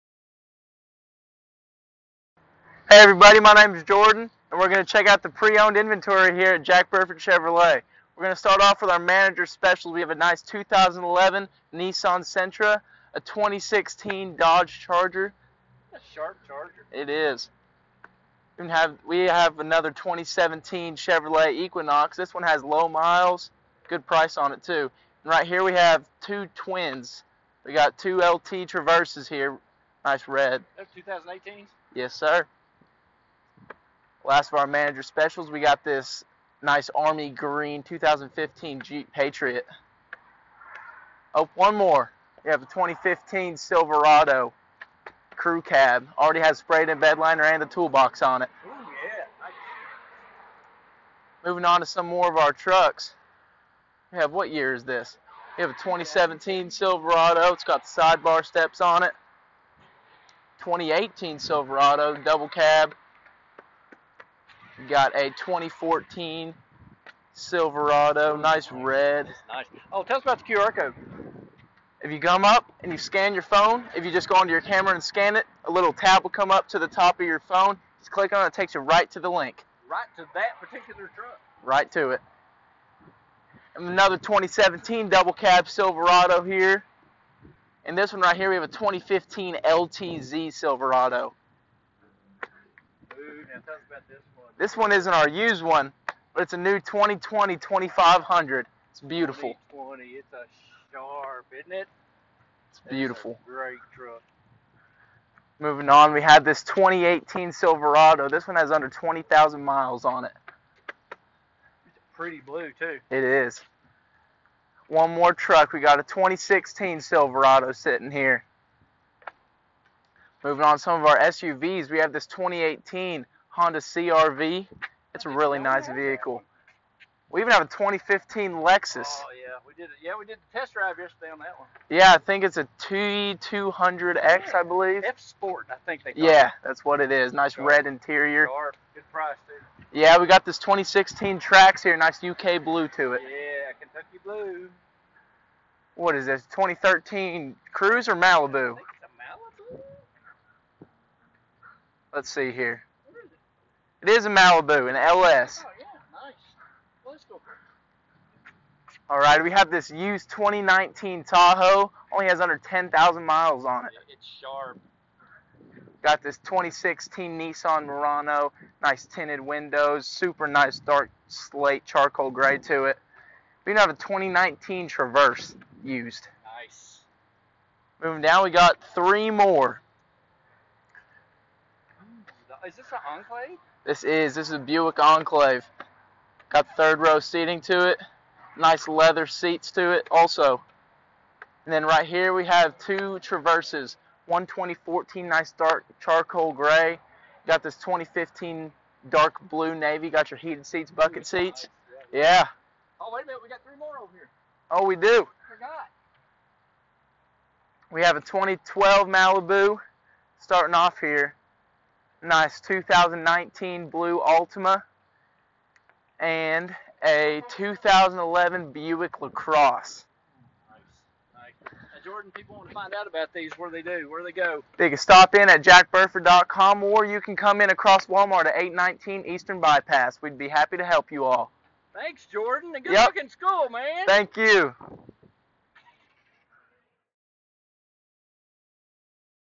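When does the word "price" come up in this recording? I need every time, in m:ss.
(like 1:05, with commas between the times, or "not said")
0:24, 2:19.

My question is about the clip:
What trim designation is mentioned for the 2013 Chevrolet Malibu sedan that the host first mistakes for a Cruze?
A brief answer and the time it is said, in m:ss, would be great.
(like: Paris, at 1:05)
LS, at 2:34.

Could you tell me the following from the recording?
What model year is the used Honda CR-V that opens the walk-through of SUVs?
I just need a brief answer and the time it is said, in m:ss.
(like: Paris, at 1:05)
2018, at 2:02.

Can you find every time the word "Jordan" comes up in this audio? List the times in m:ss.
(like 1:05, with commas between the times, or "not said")
0:03, 3:42, 3:52.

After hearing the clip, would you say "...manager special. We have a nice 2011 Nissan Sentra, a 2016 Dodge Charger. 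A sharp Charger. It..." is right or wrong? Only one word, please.
right.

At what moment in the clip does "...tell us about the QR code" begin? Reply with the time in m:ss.
1:10.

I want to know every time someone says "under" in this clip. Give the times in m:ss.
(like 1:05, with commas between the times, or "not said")
1:48, 2:42.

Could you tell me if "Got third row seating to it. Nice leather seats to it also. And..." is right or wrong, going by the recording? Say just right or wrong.
right.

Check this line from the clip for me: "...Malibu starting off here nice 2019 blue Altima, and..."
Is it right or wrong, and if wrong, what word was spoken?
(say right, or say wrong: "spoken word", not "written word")
right.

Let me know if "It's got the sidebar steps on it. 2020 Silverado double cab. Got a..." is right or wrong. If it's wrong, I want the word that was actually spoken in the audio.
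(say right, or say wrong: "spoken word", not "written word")
wrong: "2018", not "2020".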